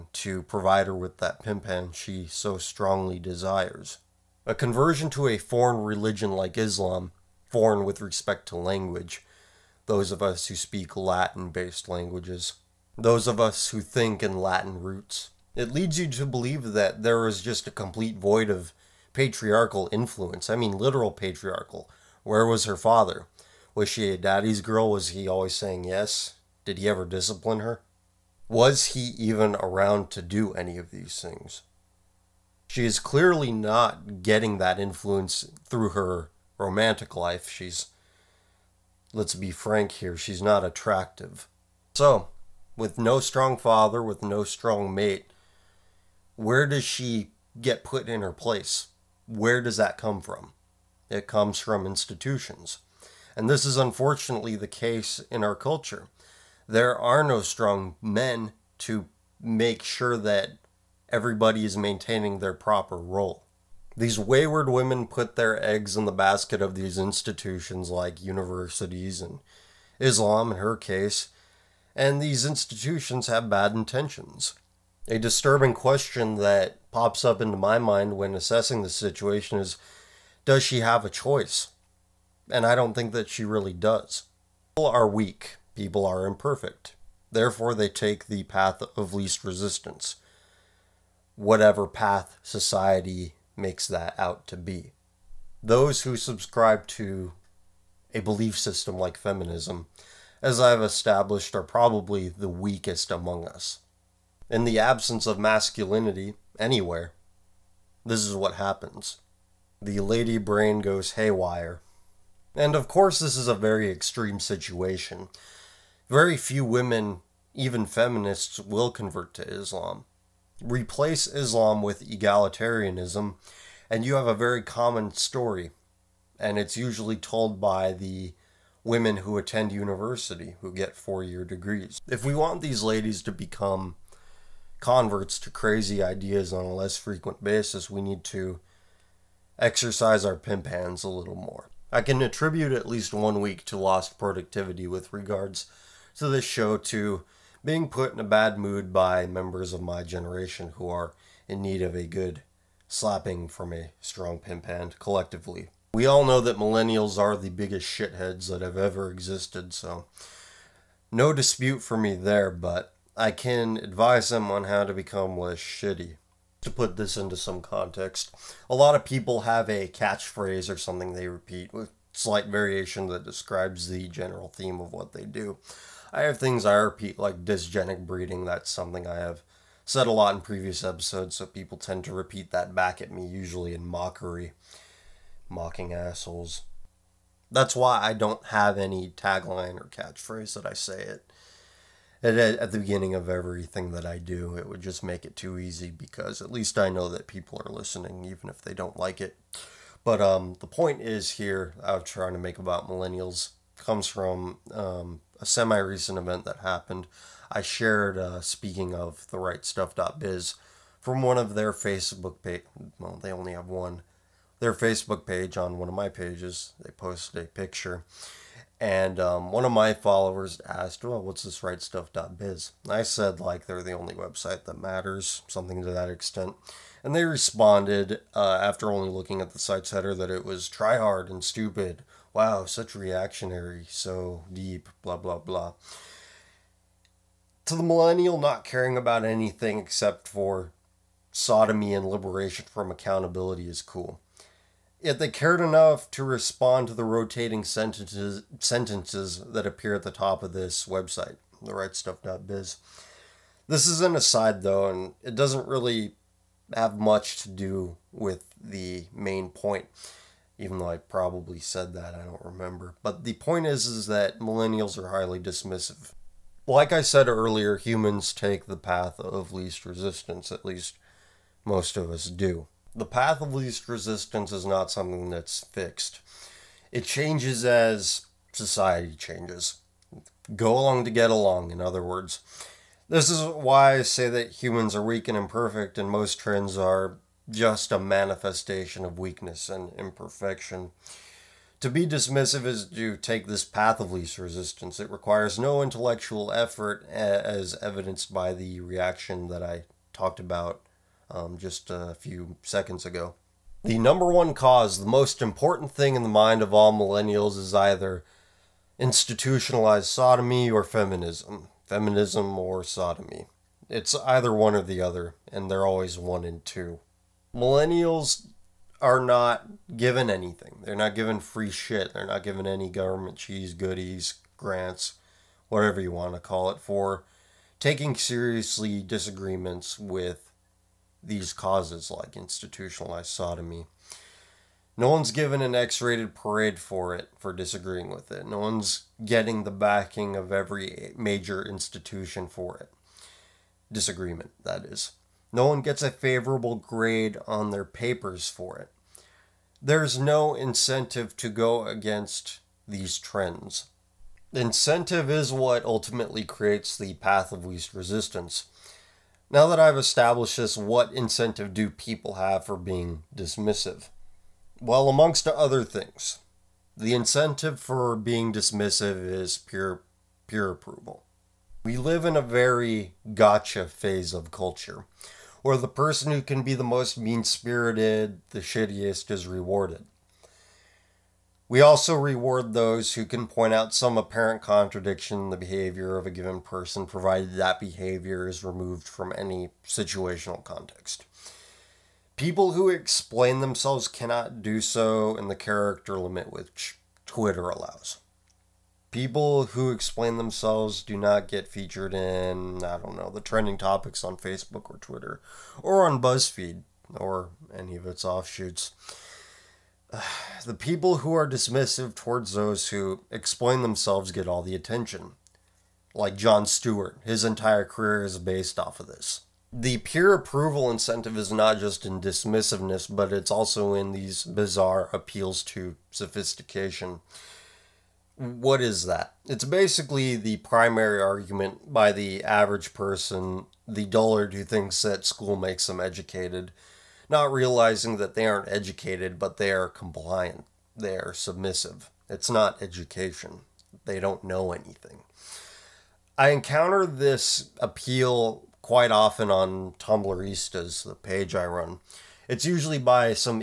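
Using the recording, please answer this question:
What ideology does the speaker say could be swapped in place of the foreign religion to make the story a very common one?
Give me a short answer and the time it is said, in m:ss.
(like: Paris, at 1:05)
egalitarianism, at 2:02.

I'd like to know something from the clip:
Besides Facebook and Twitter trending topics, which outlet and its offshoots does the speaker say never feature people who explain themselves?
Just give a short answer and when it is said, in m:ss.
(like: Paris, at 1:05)
BuzzFeed, at 6:46.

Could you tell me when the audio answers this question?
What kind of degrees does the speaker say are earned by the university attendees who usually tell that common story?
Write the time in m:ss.
2:10.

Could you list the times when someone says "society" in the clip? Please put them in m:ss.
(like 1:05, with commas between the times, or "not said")
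1:32, 4:38.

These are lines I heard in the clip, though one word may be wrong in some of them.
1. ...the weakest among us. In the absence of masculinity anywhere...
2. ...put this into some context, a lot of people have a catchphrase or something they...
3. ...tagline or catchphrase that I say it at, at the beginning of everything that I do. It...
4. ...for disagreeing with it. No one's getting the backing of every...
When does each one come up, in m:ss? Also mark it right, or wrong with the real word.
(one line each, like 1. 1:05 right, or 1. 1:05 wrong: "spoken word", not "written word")
1. 1:42 right
2. 2:46 right
3. 3:09 right
4. 5:37 right.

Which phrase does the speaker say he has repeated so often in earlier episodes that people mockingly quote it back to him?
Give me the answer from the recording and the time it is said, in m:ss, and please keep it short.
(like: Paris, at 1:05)
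dysgenic breeding, at 2:57.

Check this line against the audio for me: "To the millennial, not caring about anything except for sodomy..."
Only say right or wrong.
right.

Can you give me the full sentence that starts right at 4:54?
It requires no intellectual effort, as evidenced by the reaction that I talked about um, just a few seconds ago.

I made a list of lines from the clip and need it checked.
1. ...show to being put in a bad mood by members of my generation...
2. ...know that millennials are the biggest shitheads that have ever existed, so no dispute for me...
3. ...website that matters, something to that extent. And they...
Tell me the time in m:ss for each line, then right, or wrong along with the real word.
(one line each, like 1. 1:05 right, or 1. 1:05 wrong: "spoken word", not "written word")
1. 2:26 right
2. 2:36 right
3. 3:44 right.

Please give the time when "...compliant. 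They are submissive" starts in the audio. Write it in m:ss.
7:19.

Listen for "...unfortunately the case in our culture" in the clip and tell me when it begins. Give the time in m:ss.
0:53.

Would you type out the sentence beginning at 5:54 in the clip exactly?
Incentive is what ultimately creates the path of least resistance.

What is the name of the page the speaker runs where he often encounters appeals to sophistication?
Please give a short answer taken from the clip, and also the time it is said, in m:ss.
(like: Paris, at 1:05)
Tumblristas, at 7:29.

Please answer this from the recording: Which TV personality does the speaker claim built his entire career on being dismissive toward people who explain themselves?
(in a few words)
Jon Stewart.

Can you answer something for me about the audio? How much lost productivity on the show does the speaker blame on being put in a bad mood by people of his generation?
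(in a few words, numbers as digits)
one week.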